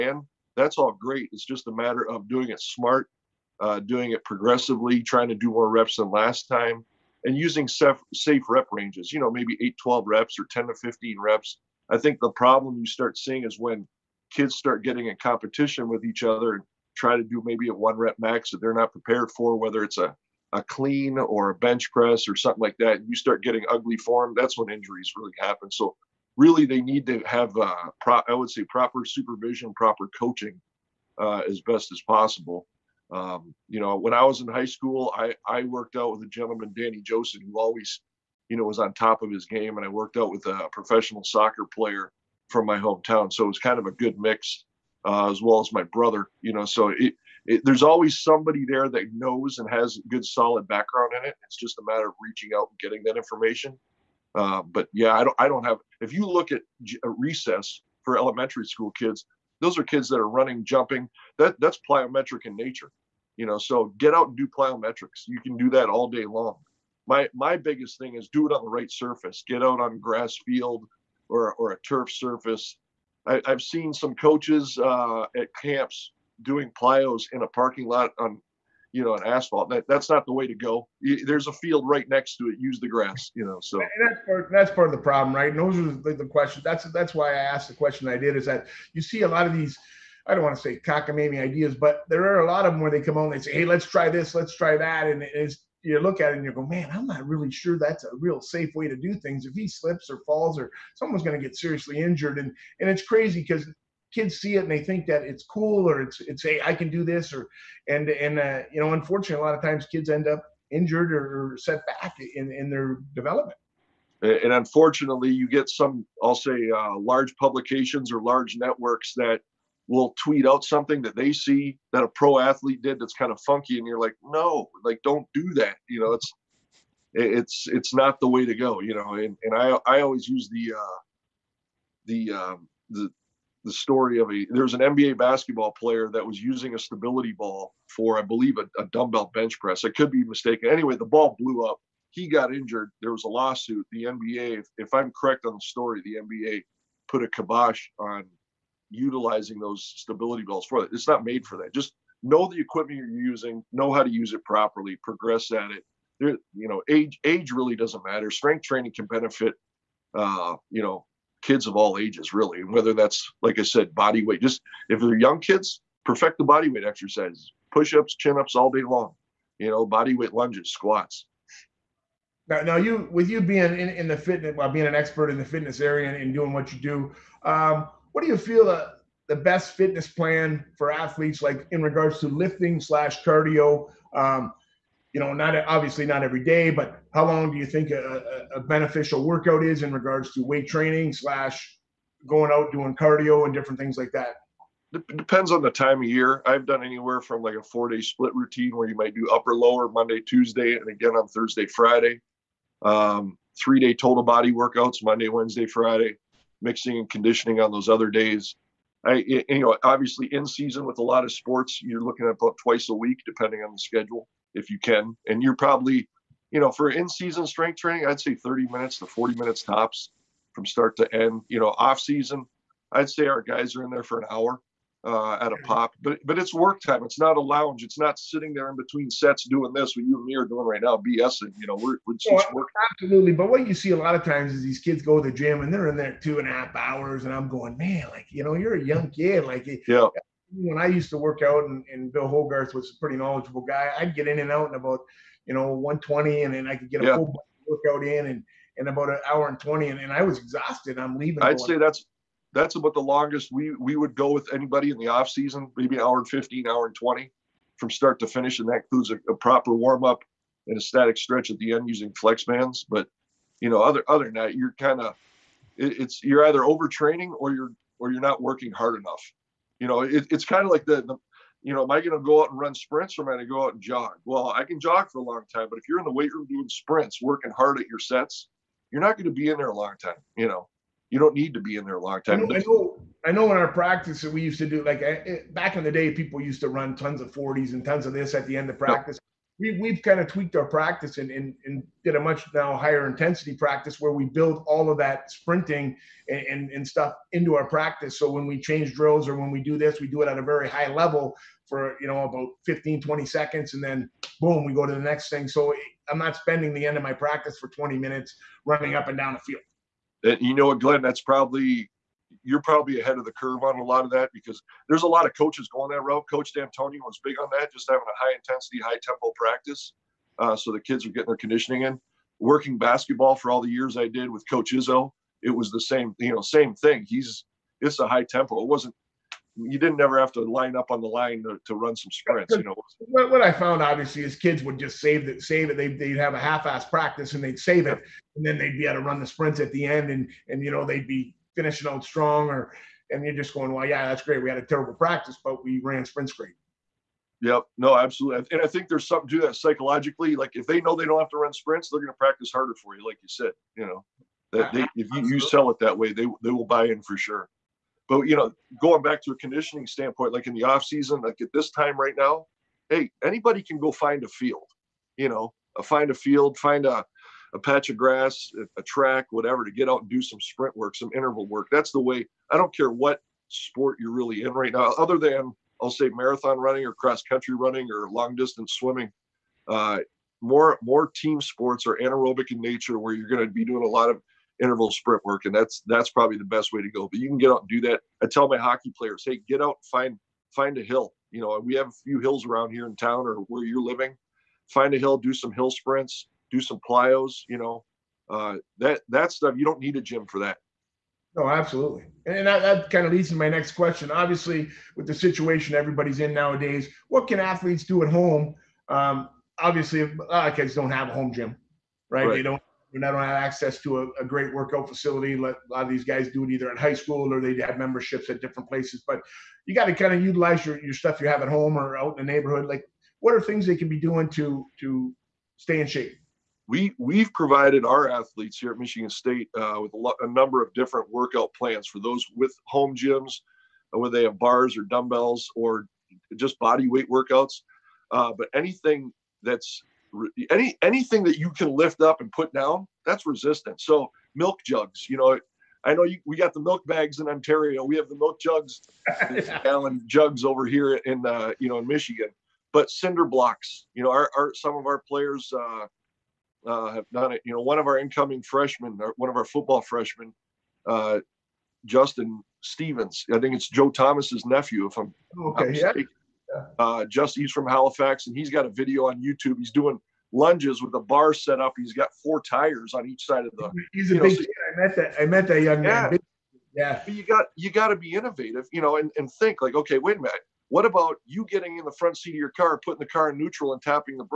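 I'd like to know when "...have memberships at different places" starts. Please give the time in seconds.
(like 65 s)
417 s.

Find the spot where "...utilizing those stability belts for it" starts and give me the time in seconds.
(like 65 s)
148 s.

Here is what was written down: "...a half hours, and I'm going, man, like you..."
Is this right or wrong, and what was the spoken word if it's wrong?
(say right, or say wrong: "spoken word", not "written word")
right.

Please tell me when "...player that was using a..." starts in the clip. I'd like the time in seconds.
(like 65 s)
135 s.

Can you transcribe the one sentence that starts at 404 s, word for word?
Obviously, with the situation everybody's in nowadays, what can athletes do at home?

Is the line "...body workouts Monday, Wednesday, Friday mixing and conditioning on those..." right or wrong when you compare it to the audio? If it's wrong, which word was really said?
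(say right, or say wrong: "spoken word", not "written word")
right.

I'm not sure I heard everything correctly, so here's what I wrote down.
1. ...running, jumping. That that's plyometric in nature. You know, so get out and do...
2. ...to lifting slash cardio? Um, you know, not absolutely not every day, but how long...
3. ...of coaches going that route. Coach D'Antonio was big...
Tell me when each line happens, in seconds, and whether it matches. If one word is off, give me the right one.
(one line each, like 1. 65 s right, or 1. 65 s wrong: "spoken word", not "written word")
1. 60 s right
2. 182 s wrong: "obviously", not "absolutely"
3. 315 s right.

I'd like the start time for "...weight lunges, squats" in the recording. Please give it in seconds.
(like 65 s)
170 s.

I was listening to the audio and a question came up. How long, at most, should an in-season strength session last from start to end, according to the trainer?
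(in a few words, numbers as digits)
40 minutes.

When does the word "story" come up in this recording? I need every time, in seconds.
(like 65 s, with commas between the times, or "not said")
133 s, 145 s.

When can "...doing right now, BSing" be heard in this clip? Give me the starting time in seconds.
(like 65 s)
230 s.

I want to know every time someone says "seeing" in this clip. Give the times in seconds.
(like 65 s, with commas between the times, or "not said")
13 s.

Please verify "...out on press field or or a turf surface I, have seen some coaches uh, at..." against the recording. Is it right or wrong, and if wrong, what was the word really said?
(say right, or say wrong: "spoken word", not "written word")
wrong: "grass", not "press".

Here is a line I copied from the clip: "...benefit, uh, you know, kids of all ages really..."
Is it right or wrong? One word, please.
right.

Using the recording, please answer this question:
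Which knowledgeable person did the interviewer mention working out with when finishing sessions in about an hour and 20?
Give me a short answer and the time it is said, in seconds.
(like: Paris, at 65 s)
Bill Hogarth, at 242 s.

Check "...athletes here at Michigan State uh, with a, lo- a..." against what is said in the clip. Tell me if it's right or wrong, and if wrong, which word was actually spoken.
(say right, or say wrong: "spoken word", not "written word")
right.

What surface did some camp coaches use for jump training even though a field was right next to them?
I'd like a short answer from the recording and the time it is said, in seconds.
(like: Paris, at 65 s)
asphalt, at 79 s.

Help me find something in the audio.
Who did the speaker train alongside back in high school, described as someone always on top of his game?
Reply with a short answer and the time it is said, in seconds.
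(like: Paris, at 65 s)
Danny Joseph, at 36 s.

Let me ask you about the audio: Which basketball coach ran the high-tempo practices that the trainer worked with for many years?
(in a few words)
Coach Izzo.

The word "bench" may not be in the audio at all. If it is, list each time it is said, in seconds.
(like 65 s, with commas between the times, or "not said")
21 s, 139 s.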